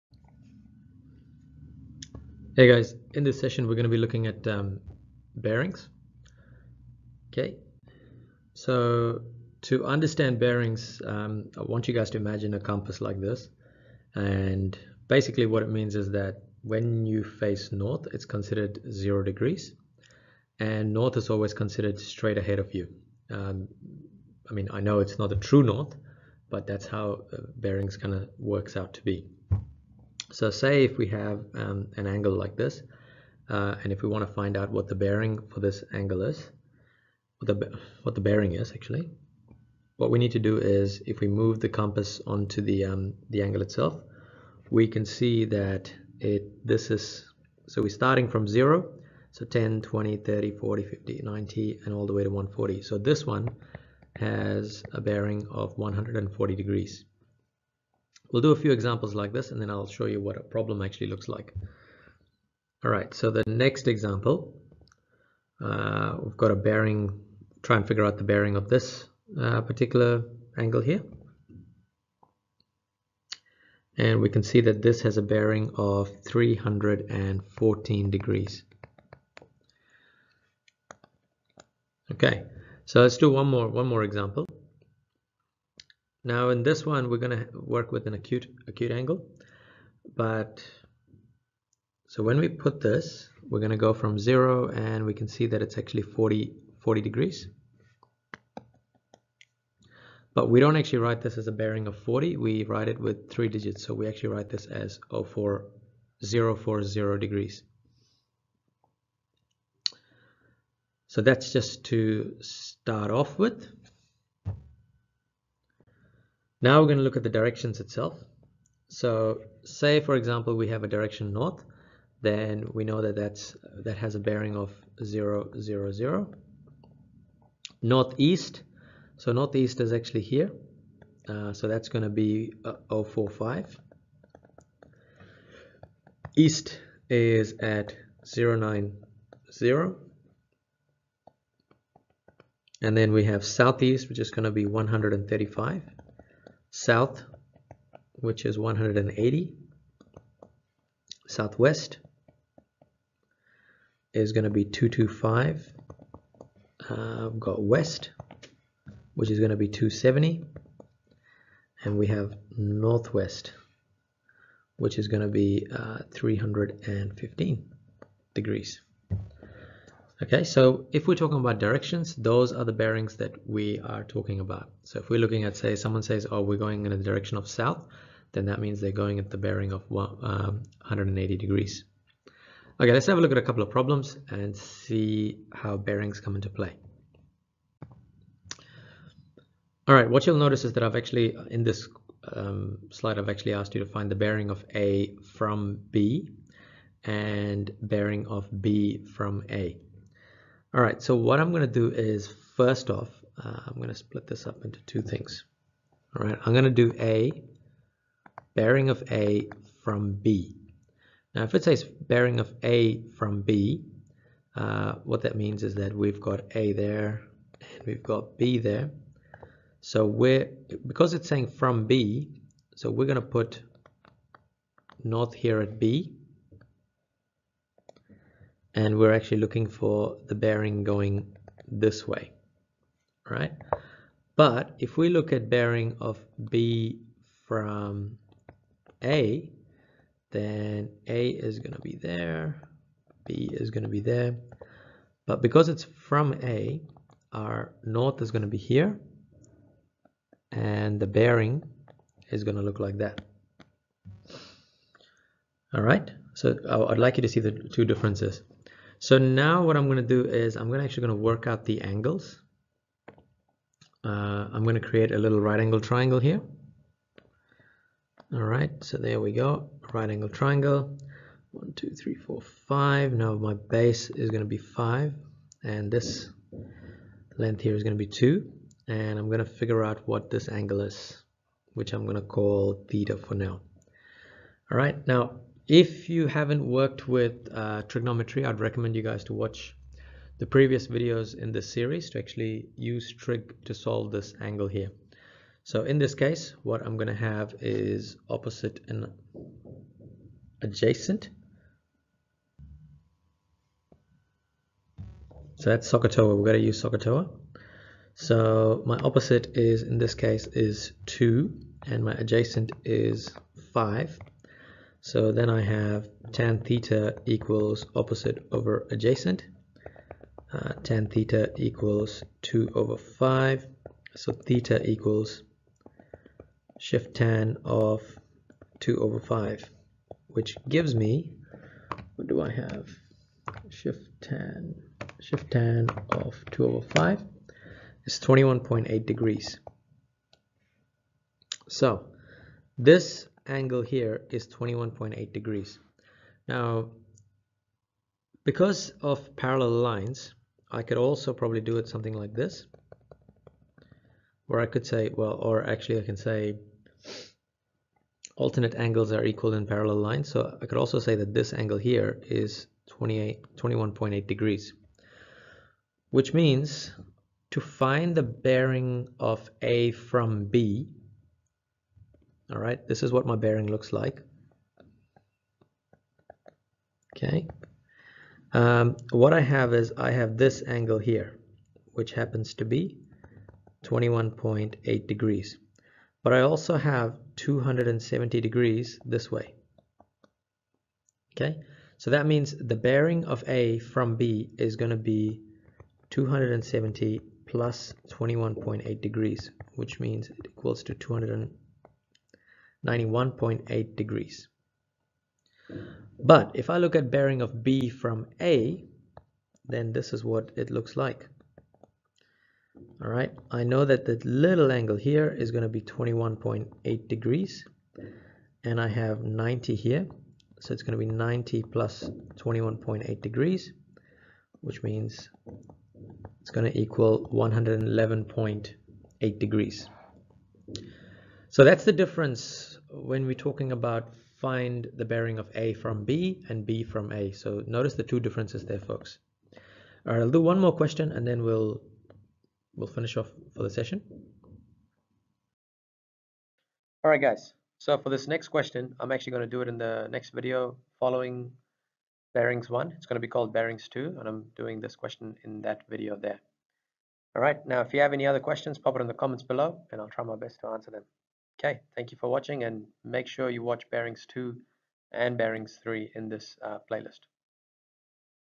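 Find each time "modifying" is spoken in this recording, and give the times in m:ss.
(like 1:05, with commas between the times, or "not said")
not said.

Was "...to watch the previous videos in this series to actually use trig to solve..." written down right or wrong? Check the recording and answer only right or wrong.
right.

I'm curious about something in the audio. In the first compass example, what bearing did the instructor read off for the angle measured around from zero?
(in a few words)
140 degrees.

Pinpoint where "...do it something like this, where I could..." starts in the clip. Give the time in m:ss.
5:51.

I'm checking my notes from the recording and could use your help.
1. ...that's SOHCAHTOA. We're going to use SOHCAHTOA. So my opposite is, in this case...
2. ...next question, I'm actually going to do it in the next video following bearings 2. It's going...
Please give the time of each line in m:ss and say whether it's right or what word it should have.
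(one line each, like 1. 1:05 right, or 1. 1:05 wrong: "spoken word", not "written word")
1. 5:05 right
2. 7:28 wrong: "1", not "2".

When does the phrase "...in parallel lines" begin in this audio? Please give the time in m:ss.
5:59.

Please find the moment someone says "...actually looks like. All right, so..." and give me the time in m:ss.
1:00.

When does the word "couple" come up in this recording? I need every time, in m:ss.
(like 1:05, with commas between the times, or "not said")
3:03.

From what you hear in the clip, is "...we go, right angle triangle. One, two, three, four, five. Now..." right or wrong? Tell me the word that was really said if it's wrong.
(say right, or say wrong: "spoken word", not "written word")
right.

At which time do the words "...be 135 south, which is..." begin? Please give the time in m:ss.
2:24.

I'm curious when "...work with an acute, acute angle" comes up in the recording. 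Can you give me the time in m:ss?
1:27.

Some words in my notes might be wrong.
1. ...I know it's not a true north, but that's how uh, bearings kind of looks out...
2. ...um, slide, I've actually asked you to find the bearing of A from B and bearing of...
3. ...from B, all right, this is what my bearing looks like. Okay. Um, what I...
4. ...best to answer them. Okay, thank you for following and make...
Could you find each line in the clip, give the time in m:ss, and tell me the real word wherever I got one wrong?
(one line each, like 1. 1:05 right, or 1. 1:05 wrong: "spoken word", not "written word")
1. 0:24 wrong: "works", not "looks"
2. 3:12 right
3. 6:09 right
4. 7:40 wrong: "watching", not "following".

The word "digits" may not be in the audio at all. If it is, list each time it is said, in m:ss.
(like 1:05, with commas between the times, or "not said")
1:43.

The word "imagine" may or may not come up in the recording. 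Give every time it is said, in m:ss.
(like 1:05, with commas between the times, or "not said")
0:12.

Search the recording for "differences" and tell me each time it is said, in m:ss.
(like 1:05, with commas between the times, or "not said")
4:17, 7:11, 7:18.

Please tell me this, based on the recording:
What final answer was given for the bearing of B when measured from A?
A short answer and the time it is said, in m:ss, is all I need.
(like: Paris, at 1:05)
111.8 degrees, at 7:07.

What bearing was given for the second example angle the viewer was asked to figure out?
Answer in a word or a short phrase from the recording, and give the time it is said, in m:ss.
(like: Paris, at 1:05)
314 degrees, at 1:16.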